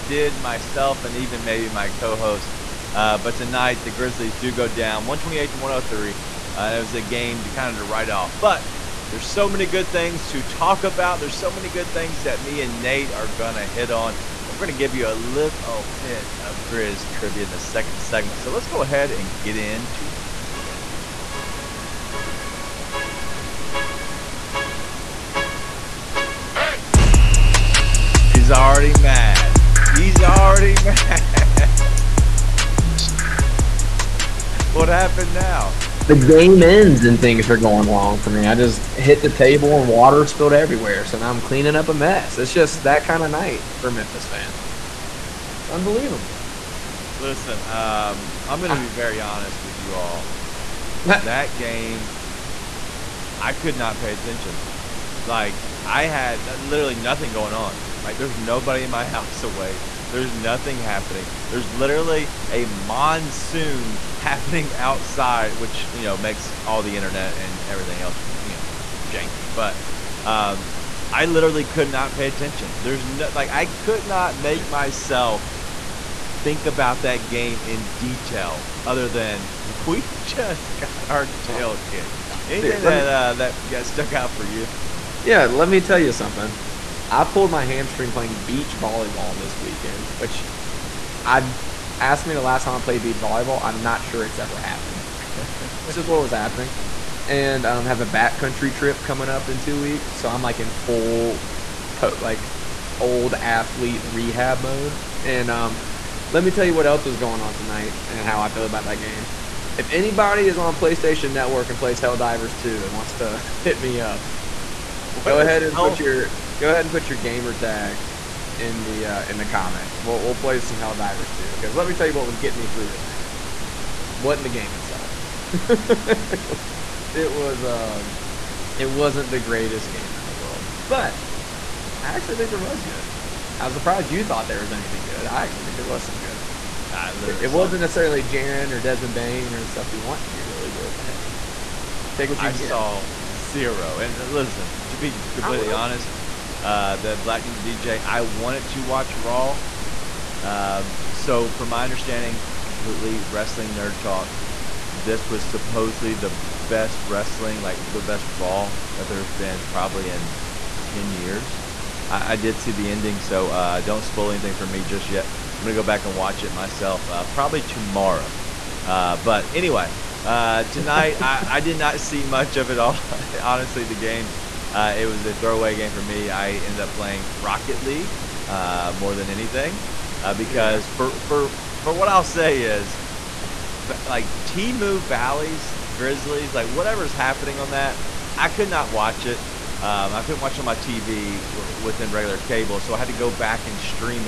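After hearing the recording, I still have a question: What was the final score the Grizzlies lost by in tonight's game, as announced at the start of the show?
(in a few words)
128 to 103.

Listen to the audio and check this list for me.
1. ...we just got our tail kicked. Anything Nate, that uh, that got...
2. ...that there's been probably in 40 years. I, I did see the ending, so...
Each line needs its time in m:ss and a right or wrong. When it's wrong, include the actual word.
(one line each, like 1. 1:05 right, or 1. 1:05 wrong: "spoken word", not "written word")
1. 1:19 wrong: "Dude", not "Nate"
2. 2:38 wrong: "10", not "40".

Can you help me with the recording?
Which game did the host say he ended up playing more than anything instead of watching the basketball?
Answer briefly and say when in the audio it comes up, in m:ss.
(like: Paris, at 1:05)
Rocket League, at 2:57.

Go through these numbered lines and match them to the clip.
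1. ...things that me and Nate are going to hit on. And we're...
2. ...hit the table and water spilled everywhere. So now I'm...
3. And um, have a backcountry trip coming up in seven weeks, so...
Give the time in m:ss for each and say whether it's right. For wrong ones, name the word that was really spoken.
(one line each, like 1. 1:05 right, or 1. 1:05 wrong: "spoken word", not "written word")
1. 0:11 right
2. 0:38 right
3. 1:37 wrong: "two", not "seven".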